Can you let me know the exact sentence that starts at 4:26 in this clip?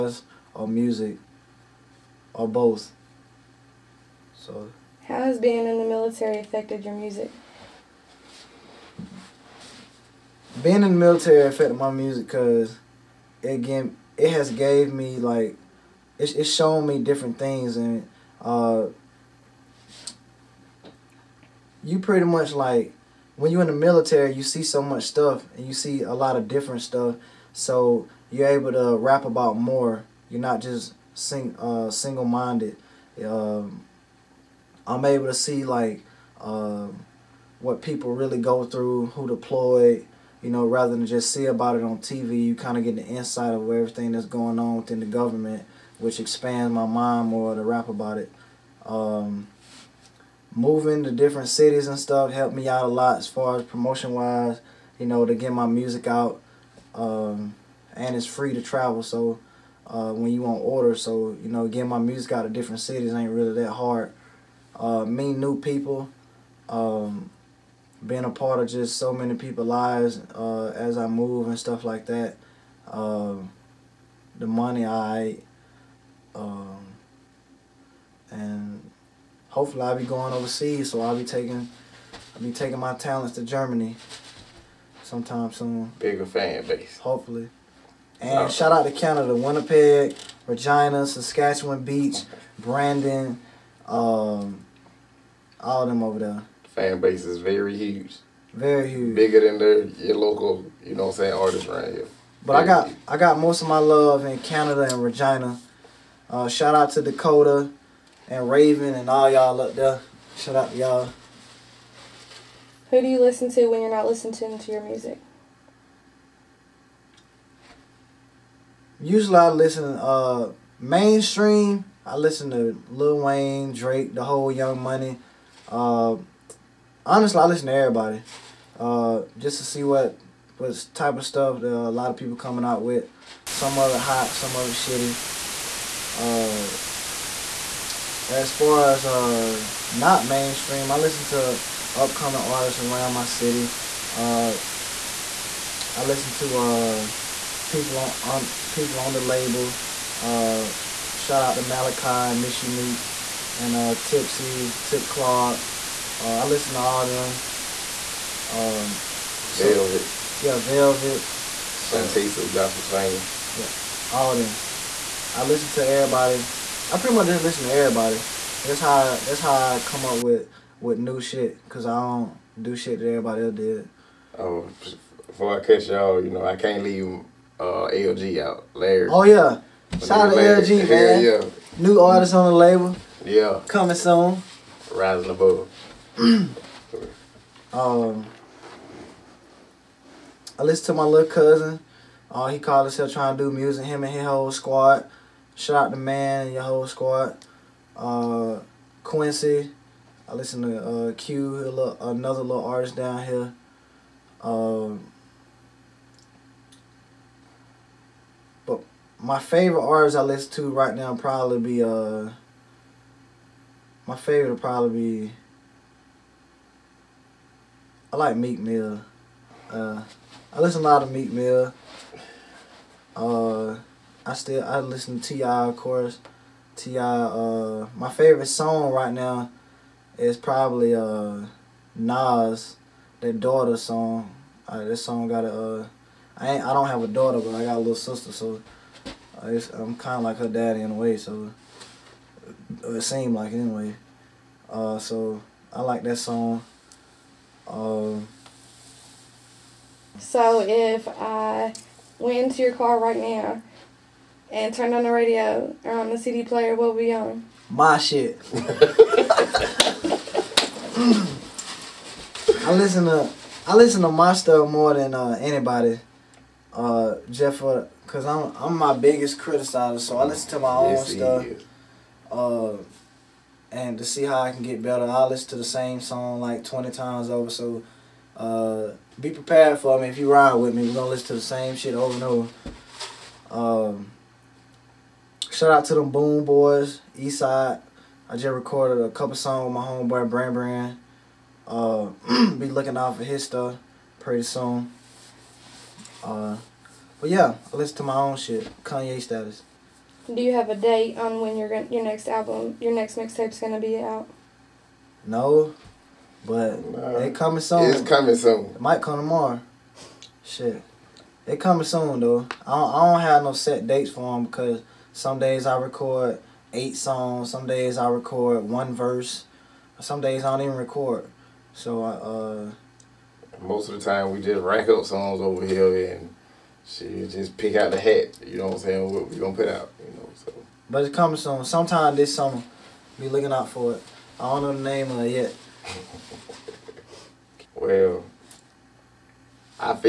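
Uh, Jeff, cause I'm I'm my biggest criticizer, so I listen to my own yes, stuff.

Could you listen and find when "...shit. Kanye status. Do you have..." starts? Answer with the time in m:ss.
4:58.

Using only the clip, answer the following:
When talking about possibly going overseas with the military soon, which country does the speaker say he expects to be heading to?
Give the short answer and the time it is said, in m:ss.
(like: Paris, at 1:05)
Germany, at 1:23.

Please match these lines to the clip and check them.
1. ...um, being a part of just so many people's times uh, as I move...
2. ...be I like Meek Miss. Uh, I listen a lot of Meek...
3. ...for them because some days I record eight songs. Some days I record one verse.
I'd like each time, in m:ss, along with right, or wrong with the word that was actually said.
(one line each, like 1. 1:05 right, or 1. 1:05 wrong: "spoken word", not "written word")
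1. 1:06 wrong: "lives", not "times"
2. 3:34 wrong: "Mill", not "Miss"
3. 5:14 right.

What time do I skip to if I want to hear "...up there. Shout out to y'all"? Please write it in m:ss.
1:49.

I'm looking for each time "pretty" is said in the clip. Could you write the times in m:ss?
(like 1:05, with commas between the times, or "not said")
0:21, 2:46, 4:54.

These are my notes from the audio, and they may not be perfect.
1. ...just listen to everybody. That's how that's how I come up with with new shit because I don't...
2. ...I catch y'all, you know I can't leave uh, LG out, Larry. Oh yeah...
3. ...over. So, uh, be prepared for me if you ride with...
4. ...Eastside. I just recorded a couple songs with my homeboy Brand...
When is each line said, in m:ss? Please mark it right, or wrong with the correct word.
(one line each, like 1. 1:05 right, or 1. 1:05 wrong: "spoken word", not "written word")
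1. 2:47 right
2. 2:55 right
3. 4:37 right
4. 4:47 right.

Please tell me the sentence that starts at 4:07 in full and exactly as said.
Um, so if I went into your car right now and turned on the radio or um, on the CD player.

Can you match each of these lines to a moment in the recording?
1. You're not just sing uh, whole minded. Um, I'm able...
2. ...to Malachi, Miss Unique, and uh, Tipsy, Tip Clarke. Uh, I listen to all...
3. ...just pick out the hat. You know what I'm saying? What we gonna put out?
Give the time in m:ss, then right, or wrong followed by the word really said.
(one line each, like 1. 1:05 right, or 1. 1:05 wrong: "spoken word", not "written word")
1. 0:30 wrong: "single", not "whole"
2. 2:31 right
3. 5:27 right.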